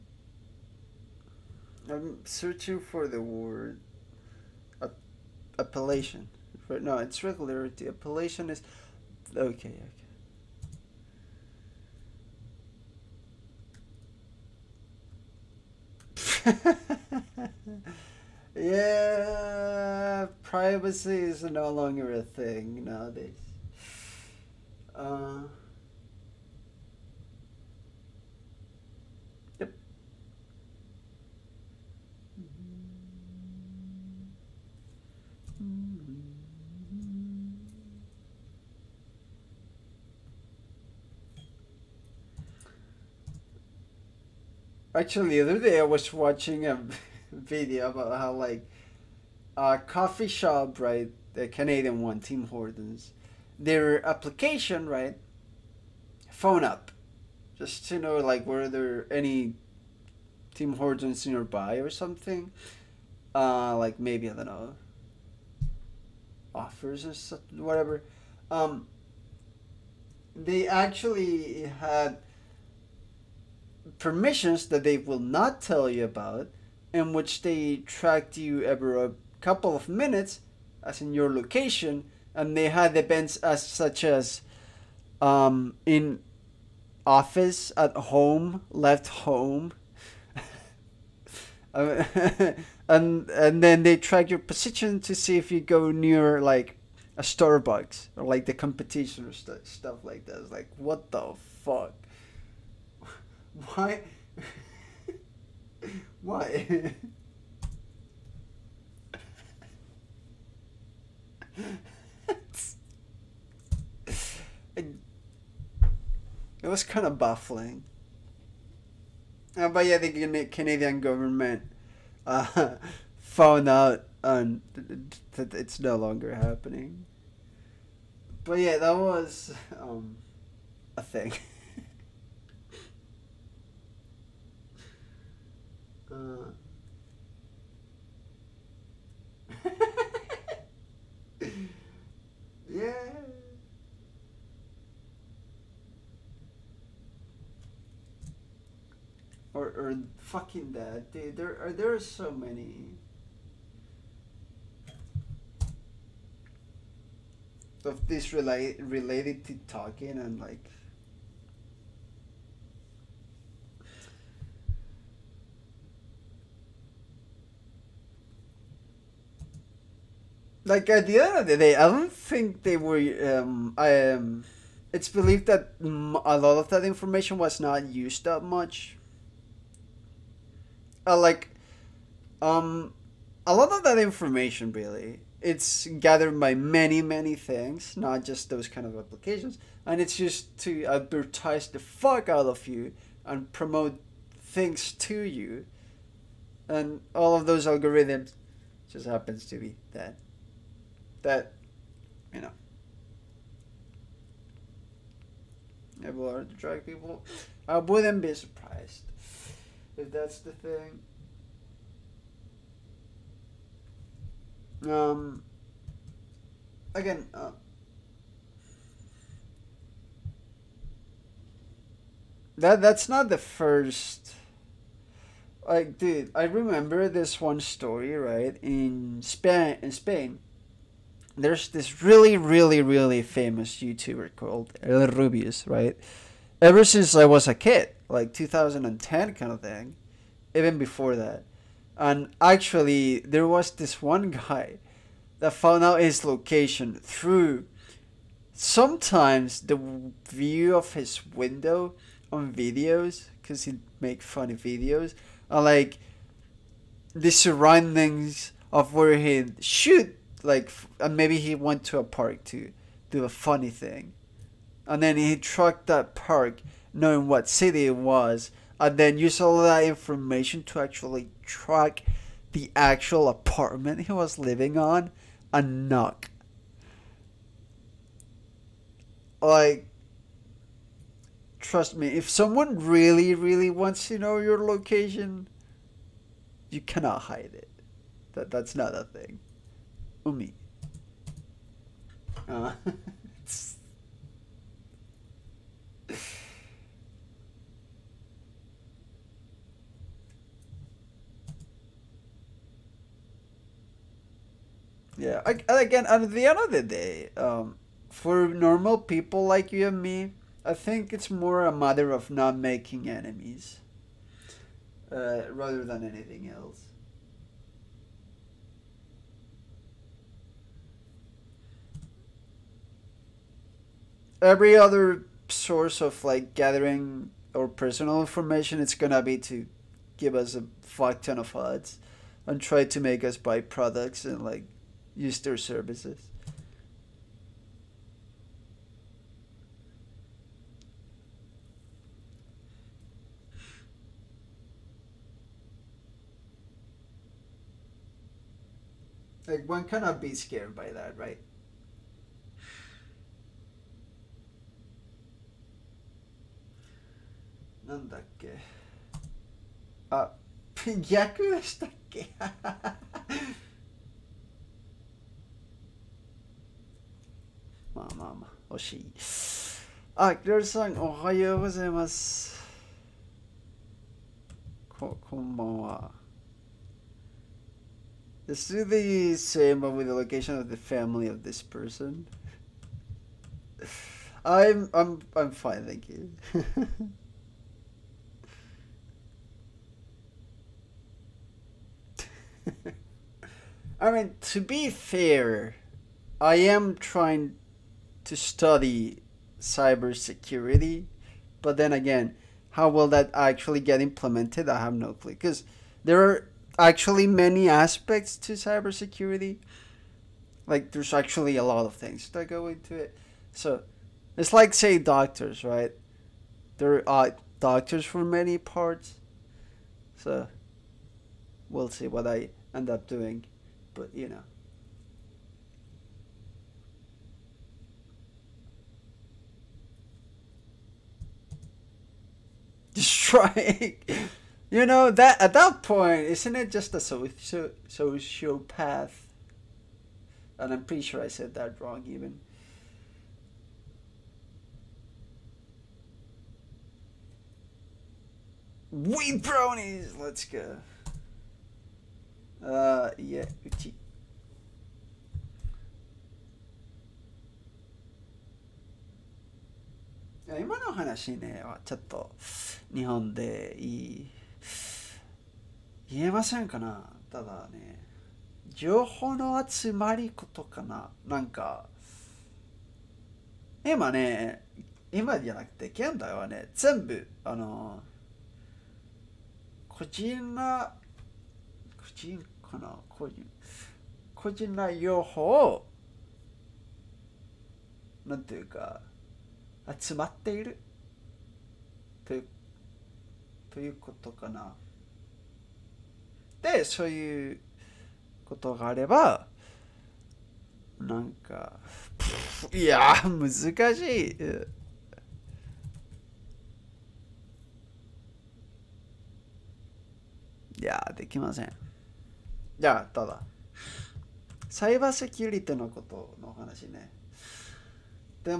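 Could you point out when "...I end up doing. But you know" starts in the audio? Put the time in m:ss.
7:02.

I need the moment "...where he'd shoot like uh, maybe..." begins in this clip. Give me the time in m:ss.
4:18.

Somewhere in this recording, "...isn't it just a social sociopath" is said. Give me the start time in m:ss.
7:16.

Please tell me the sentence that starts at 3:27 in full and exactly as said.
I wouldn't be surprised if that's the thing.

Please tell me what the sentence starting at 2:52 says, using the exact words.
Um, I um, it's believed that a lot of that information was not used that much.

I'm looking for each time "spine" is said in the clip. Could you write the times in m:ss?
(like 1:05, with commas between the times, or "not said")
not said.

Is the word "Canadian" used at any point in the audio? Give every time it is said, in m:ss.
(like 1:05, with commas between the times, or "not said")
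0:51, 2:00.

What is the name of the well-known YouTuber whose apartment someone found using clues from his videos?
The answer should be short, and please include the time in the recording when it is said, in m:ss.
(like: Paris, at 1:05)
El Rubius, at 3:54.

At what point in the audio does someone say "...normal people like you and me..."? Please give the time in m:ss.
5:08.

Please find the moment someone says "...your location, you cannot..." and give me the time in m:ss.
4:44.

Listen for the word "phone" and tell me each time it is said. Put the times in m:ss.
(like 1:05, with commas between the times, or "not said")
0:56.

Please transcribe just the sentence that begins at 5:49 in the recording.
Like one cannot be scared by that, right?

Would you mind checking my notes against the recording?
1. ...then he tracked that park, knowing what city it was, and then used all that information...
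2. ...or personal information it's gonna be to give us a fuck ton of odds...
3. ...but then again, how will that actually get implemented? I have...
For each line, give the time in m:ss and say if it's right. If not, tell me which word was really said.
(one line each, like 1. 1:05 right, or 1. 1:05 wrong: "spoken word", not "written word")
1. 4:25 right
2. 5:27 right
3. 6:41 right.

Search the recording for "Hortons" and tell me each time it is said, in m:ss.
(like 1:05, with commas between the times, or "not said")
0:52, 1:00.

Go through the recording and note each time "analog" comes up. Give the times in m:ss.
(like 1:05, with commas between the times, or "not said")
not said.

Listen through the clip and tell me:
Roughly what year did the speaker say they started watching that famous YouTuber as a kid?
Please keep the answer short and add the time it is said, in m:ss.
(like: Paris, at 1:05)
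2010, at 3:58.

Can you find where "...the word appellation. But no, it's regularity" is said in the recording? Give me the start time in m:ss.
0:03.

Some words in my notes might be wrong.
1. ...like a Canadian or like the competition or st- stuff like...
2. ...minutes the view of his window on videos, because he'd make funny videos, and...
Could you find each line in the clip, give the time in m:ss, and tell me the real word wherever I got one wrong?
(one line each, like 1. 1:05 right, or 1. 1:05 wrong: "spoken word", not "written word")
1. 1:36 wrong: "Starbucks", not "Canadian"
2. 4:08 wrong: "sometimes", not "minutes".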